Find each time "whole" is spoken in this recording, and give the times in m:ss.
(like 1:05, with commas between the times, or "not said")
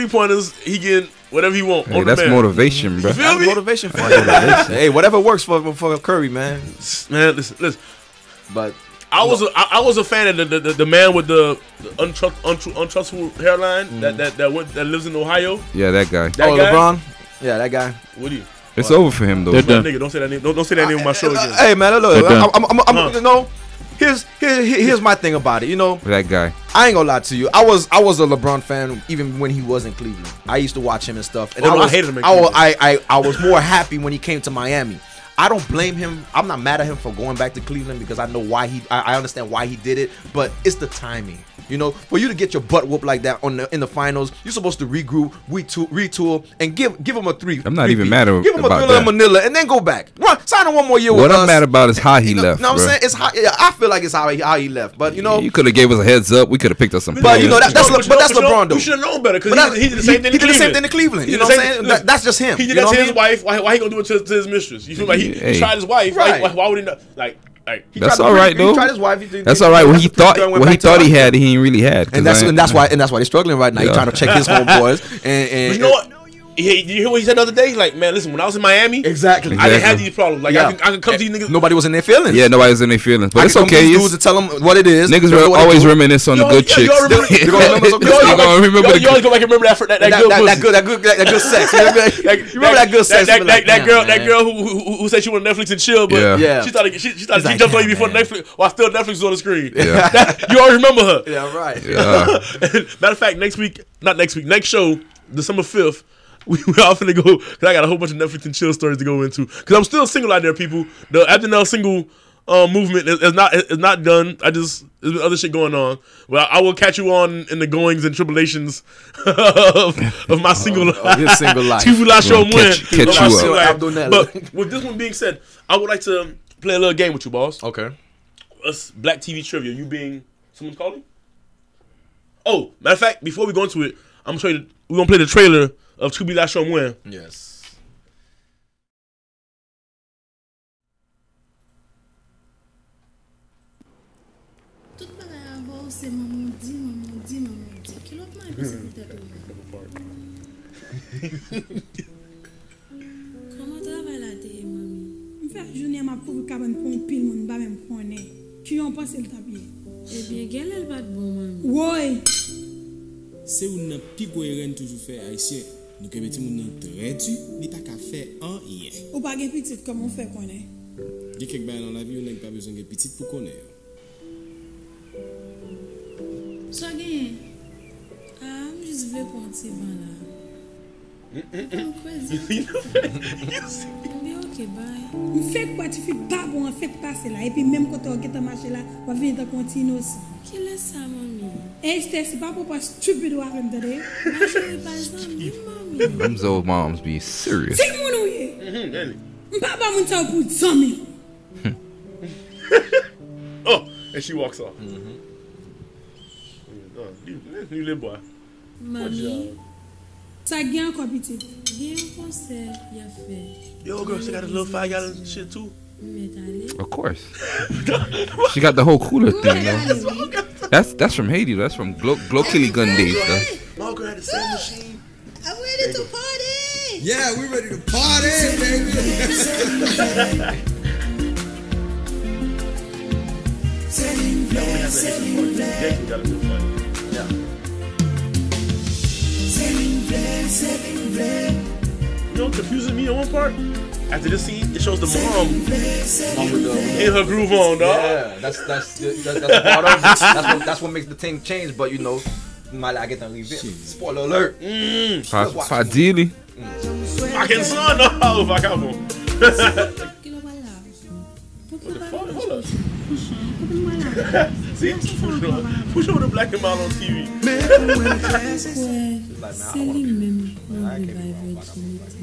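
1:47, 3:38.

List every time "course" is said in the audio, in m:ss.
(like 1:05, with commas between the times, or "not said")
3:36.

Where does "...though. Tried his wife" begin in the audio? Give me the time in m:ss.
1:08.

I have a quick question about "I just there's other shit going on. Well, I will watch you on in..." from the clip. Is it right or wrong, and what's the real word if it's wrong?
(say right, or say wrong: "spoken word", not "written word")
wrong: "catch", not "watch".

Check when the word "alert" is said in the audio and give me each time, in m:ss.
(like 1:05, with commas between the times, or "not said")
4:14.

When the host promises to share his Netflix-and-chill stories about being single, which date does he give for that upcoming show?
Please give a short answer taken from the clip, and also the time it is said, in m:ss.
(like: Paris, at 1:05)
December 5, at 1:45.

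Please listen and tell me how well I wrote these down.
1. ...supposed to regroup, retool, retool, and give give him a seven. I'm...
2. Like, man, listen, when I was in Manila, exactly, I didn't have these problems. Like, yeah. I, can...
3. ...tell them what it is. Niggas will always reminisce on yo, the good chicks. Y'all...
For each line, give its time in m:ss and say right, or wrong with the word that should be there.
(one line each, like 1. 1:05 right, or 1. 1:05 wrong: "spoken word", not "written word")
1. 0:44 wrong: "three", not "seven"
2. 1:17 wrong: "Miami", not "Manila"
3. 1:24 right.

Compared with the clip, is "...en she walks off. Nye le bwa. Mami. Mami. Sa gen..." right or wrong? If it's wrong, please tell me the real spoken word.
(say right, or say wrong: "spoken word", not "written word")
right.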